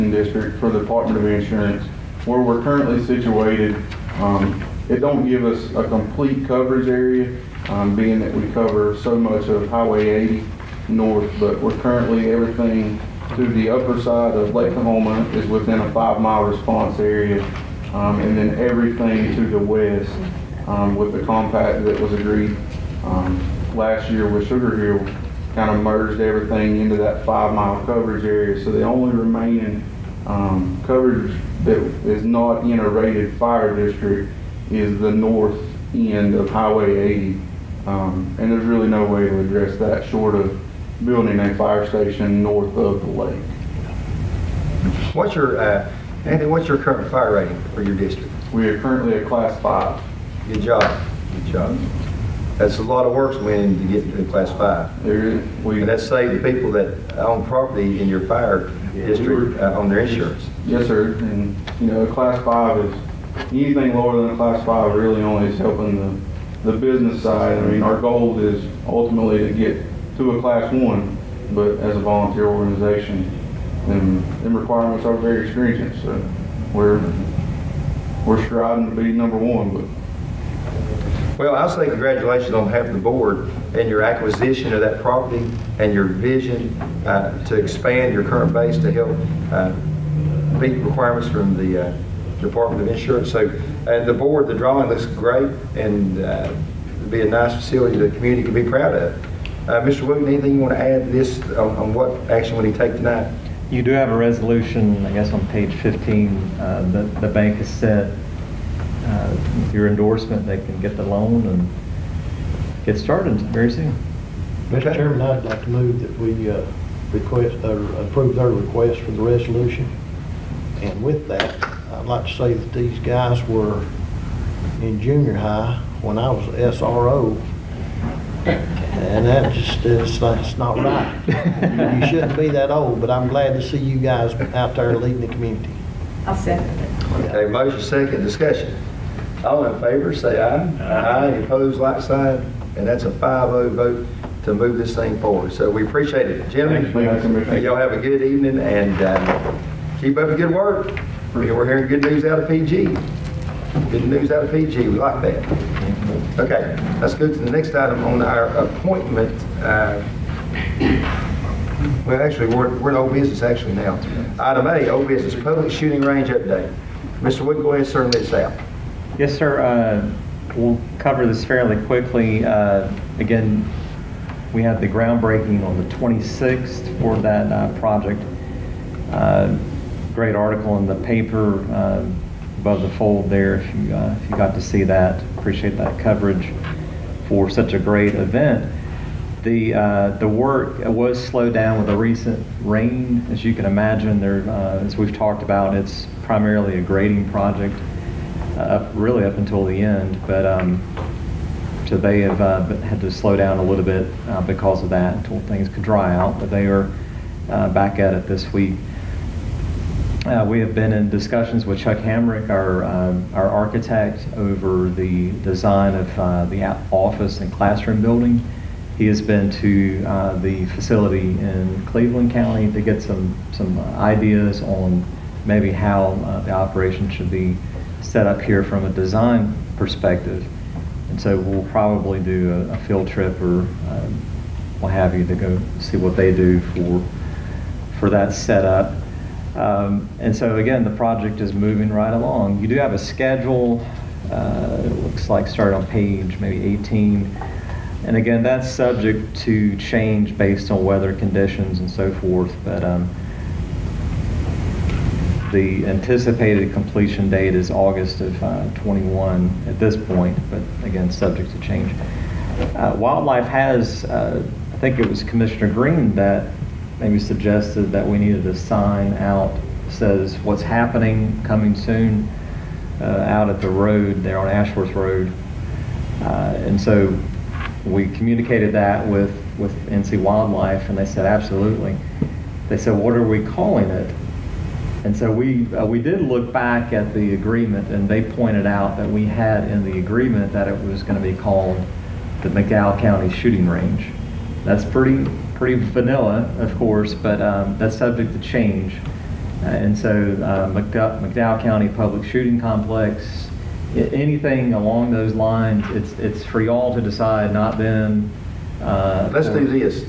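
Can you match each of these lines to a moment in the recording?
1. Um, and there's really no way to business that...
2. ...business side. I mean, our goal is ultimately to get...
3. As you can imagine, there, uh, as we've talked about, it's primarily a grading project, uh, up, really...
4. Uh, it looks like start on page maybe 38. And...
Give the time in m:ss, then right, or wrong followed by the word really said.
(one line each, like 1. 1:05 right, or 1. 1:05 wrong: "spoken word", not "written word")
1. 0:37 wrong: "address", not "business"
2. 1:06 right
3. 3:13 right
4. 4:04 wrong: "18", not "38".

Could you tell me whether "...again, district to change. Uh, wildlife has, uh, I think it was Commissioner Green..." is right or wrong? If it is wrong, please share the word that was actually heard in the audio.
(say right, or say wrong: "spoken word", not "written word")
wrong: "subject", not "district".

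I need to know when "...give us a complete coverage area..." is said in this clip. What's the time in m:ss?
0:05.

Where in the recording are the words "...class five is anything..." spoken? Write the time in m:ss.
1:02.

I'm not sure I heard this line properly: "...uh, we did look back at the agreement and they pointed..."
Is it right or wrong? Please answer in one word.
right.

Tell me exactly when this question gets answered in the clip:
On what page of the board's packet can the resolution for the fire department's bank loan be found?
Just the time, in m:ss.
1:45.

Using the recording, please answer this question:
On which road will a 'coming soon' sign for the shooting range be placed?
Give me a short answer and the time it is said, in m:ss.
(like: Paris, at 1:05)
Ashworth Road, at 4:34.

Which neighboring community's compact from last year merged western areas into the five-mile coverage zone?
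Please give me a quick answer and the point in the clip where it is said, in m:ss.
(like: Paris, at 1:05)
Sugar Hill, at 0:24.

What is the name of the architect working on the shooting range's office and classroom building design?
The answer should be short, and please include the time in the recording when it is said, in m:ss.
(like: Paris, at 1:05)
Chuck Hamrick, at 3:31.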